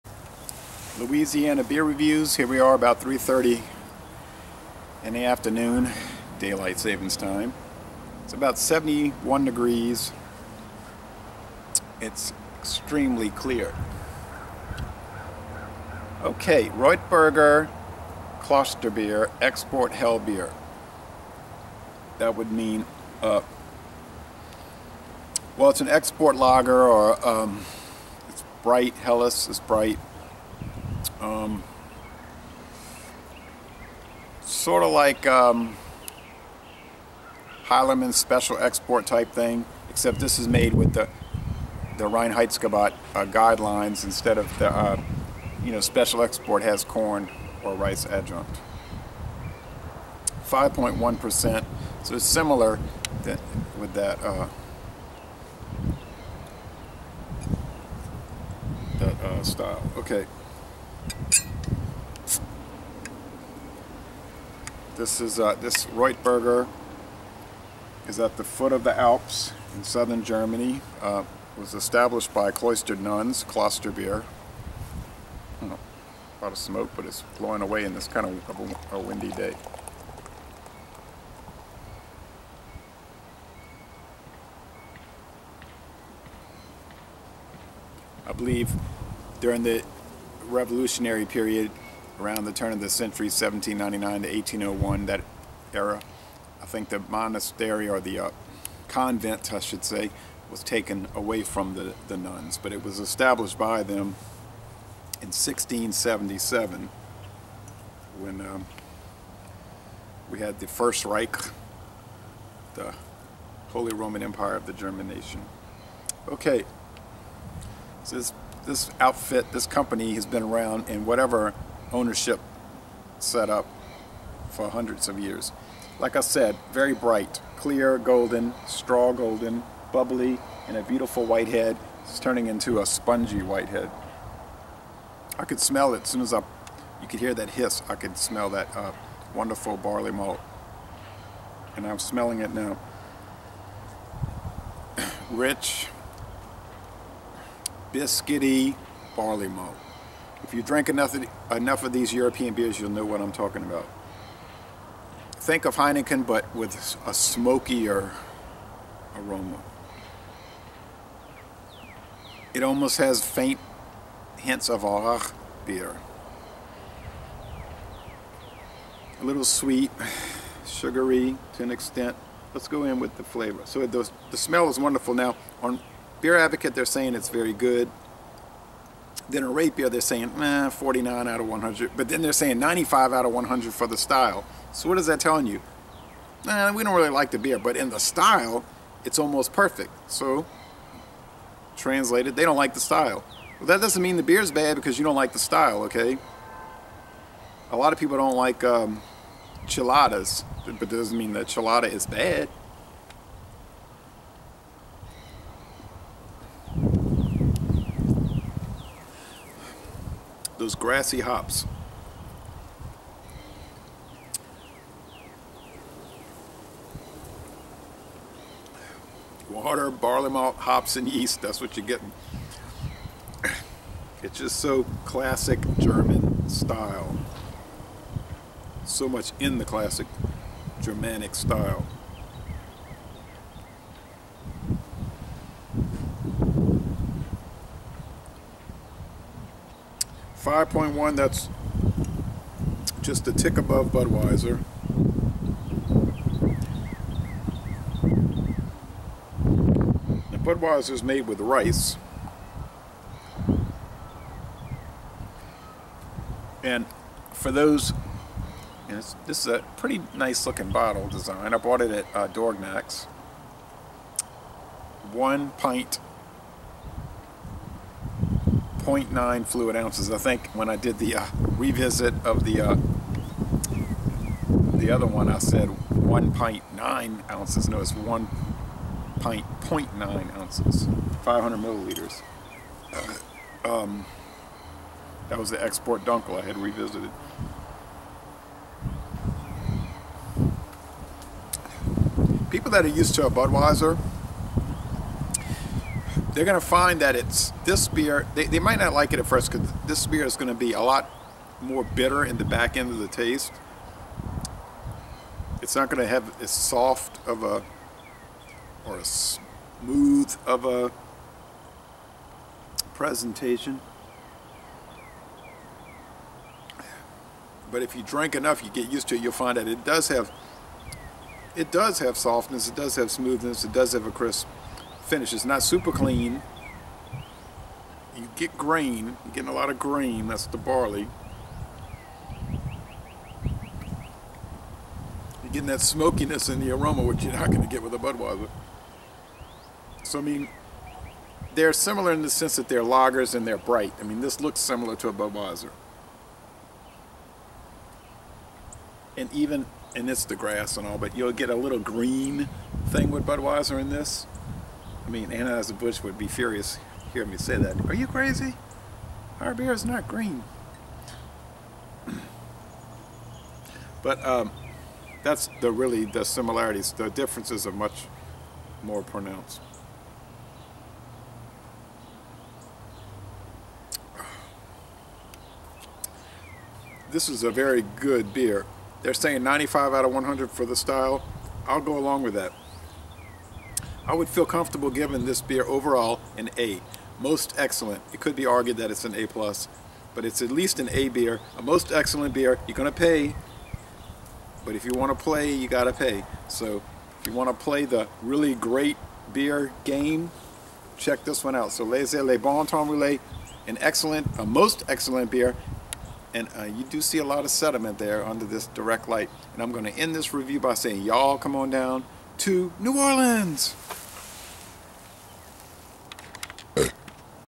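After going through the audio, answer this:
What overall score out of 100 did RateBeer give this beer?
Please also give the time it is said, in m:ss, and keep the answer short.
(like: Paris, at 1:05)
49, at 3:00.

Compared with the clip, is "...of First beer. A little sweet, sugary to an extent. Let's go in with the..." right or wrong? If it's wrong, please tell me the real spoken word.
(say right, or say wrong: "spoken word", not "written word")
wrong: "Aurach", not "First".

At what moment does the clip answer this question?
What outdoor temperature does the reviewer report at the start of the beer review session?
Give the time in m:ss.
0:08.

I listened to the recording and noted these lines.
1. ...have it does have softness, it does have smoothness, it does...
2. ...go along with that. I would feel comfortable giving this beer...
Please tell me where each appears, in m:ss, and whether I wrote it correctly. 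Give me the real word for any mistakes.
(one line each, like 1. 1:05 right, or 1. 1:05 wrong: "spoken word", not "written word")
1. 5:20 right
2. 6:21 right.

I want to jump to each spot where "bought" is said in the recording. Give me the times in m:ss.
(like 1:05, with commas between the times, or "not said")
4:21.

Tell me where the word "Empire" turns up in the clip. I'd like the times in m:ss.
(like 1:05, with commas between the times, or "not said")
1:54.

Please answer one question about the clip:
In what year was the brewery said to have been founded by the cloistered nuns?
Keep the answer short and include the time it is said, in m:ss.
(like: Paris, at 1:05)
1677, at 1:45.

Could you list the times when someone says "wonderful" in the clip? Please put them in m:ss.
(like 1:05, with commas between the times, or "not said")
2:19, 2:54.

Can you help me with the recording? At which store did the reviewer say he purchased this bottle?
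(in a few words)
Dorignac's.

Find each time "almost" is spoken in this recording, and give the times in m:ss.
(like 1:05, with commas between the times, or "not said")
2:42, 3:09.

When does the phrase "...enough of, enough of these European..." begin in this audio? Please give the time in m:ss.
2:30.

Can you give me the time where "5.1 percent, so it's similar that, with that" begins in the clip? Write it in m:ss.
0:50.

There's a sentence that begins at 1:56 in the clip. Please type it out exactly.
Okay, so this, this outfit, this company has been around in whatever ownership set up for hundreds of years.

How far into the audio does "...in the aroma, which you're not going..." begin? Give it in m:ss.
5:36.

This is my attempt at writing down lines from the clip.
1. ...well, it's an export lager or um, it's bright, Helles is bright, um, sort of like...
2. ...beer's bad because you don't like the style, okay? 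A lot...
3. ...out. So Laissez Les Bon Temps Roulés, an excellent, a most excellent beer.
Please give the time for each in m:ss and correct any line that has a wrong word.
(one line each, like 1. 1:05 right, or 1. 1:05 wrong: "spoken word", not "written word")
1. 0:25 right
2. 3:14 right
3. 6:41 right.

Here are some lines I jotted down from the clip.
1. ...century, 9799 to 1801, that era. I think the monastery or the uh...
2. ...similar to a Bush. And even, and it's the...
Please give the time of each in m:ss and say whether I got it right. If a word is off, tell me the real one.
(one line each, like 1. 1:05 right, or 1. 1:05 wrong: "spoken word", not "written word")
1. 1:32 wrong: "1799", not "9799"
2. 5:44 wrong: "Budweiser", not "Bush".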